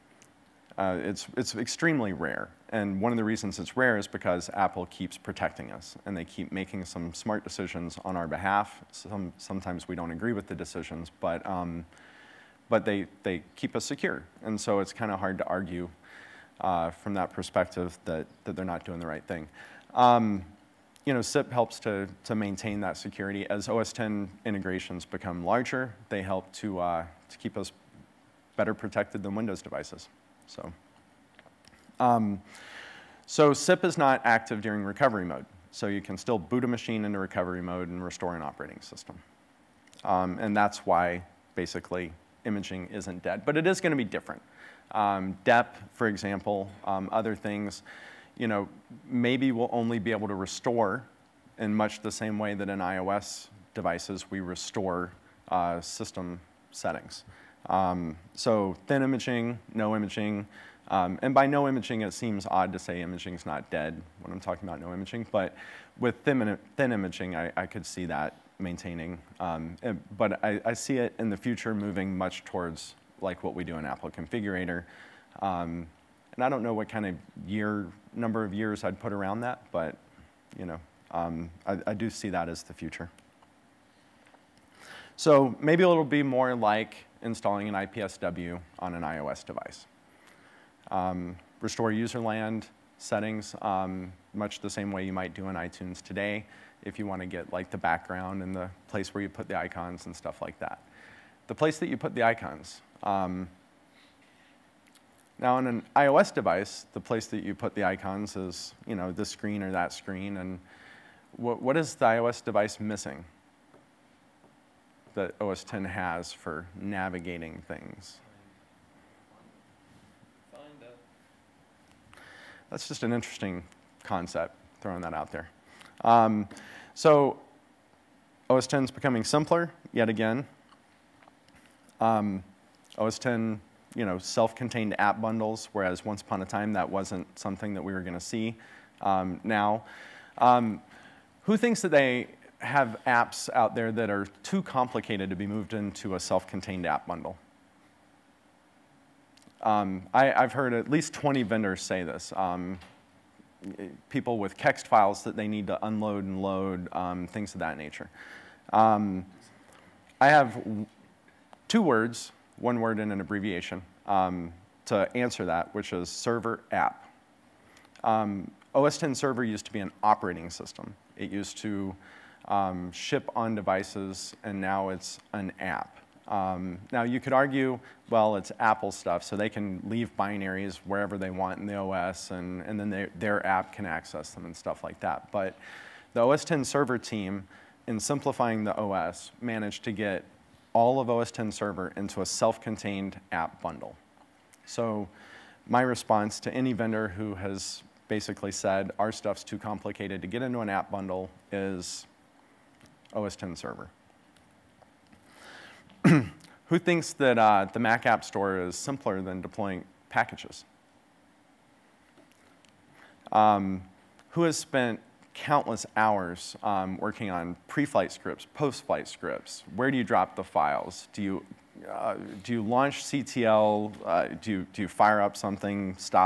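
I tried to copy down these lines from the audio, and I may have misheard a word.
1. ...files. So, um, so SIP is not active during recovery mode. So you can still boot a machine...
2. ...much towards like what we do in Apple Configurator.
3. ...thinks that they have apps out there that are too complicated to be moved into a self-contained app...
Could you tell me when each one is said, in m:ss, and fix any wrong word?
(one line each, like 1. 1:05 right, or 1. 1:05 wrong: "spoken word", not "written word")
1. 0:29 wrong: "devices", not "files"
2. 1:12 right
3. 2:21 right.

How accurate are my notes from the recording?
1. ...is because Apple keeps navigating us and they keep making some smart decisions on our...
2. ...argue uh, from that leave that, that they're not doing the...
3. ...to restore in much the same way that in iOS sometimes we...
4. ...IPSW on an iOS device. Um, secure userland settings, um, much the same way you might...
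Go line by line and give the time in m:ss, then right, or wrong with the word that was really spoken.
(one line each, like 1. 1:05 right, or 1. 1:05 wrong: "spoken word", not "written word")
1. 0:03 wrong: "protecting", not "navigating"
2. 0:15 wrong: "perspective", not "leave"
3. 0:50 wrong: "devices", not "sometimes"
4. 1:27 wrong: "restore", not "secure".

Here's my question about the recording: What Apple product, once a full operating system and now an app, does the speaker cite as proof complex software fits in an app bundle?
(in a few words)
Server app.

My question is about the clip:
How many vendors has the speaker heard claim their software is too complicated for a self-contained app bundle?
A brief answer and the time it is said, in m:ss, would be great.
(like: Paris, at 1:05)
20, at 2:31.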